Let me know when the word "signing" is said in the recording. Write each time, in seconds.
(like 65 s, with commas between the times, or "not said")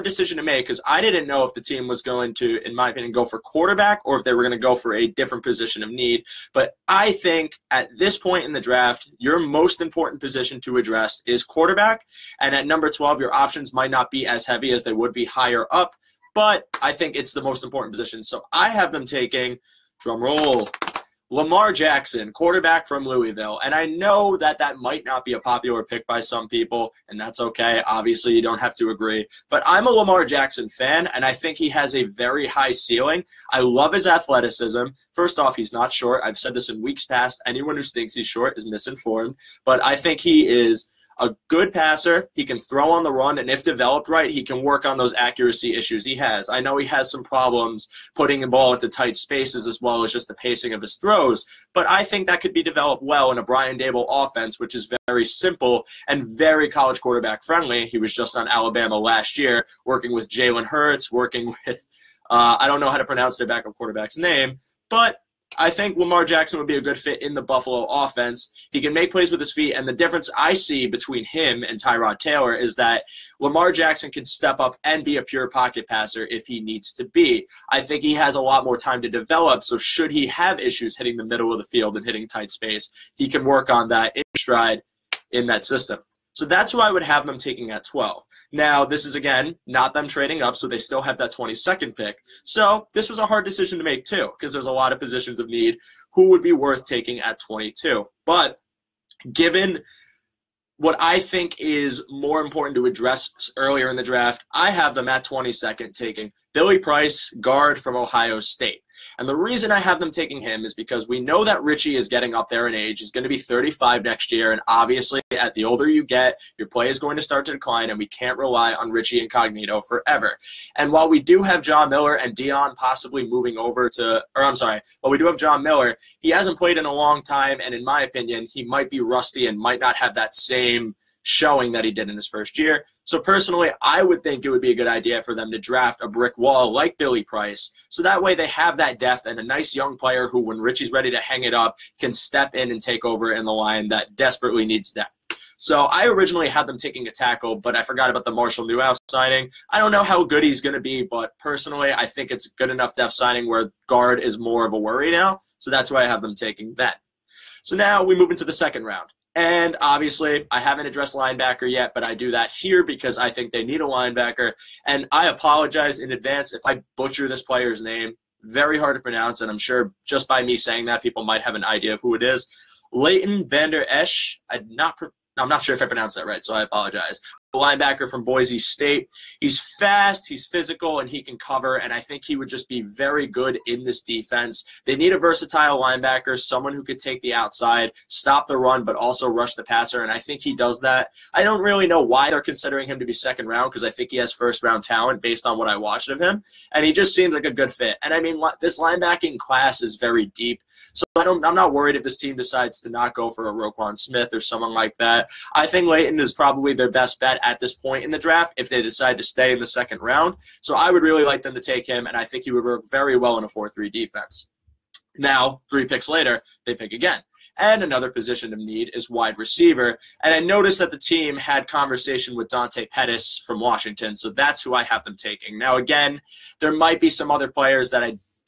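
149 s, 153 s.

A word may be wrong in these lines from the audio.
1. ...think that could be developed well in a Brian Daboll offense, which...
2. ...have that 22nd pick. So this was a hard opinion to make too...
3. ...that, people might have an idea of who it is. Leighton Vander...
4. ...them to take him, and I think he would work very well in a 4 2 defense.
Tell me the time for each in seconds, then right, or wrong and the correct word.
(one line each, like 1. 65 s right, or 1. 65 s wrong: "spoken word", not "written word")
1. 52 s right
2. 91 s wrong: "decision", not "opinion"
3. 170 s right
4. 211 s wrong: "3", not "2".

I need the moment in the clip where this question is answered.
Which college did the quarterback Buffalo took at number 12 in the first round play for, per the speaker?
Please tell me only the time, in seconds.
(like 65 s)
23 s.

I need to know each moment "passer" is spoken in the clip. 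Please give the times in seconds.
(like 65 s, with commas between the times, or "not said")
41 s, 75 s, 189 s.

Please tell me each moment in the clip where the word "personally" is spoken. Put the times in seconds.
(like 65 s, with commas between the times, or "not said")
133 s, 151 s.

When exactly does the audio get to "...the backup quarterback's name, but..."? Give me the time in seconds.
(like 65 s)
63 s.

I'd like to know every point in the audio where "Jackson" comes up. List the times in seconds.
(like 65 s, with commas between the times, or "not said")
21 s, 30 s, 66 s, 73 s.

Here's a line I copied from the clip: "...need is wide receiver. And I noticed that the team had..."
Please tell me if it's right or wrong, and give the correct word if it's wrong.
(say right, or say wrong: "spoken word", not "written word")
right.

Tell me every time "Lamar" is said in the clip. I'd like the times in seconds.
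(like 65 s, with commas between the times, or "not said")
21 s, 29 s, 65 s, 73 s.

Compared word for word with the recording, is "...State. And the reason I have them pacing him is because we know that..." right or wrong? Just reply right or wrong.
wrong.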